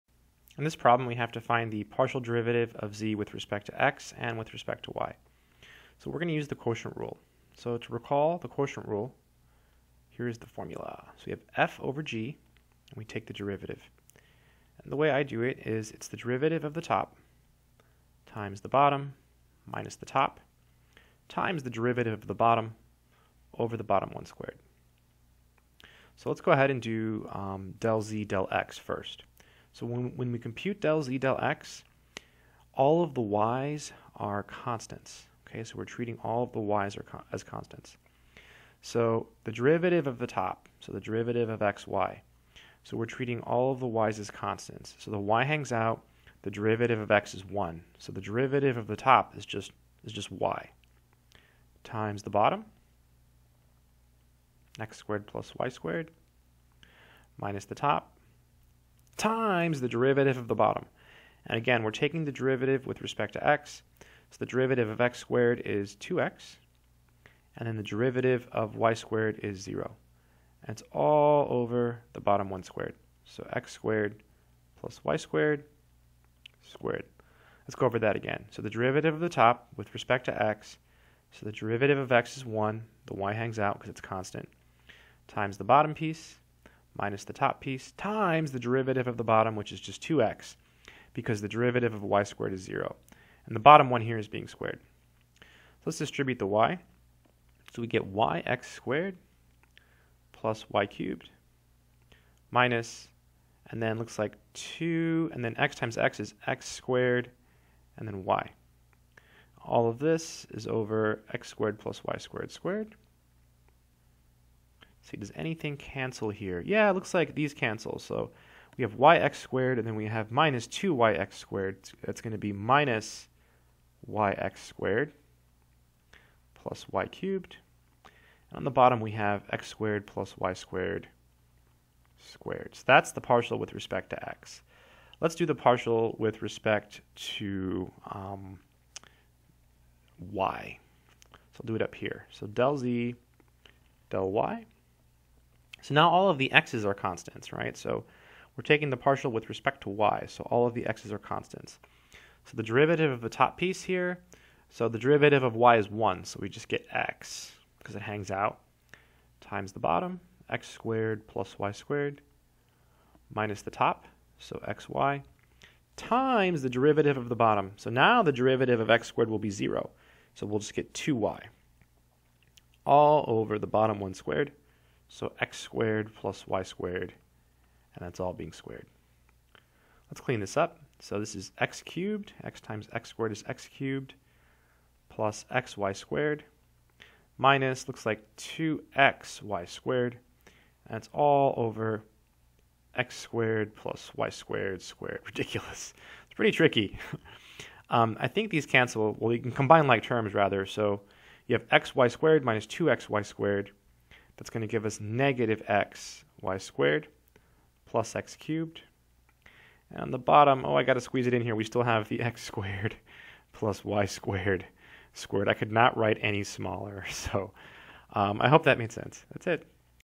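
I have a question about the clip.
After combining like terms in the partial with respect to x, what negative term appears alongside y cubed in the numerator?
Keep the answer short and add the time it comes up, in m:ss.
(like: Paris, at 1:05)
minus yx squared, at 2:02.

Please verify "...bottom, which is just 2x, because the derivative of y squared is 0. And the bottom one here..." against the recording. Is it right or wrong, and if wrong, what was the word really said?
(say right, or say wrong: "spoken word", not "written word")
right.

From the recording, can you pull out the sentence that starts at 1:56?
Yeah, it looks like these cancel.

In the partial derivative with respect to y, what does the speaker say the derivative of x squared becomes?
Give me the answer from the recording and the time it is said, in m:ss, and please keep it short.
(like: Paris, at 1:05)
0, at 2:48.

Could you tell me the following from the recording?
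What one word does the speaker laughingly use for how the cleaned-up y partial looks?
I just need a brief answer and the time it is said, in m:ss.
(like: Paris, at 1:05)
Ridiculous, at 3:15.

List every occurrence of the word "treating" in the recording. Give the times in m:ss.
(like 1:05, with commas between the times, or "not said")
0:35, 0:43.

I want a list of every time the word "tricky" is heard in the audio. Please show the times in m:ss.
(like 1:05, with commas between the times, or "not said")
3:16.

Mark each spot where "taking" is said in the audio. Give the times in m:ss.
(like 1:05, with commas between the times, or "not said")
1:01, 2:28.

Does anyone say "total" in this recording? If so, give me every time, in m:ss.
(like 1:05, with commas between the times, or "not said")
not said.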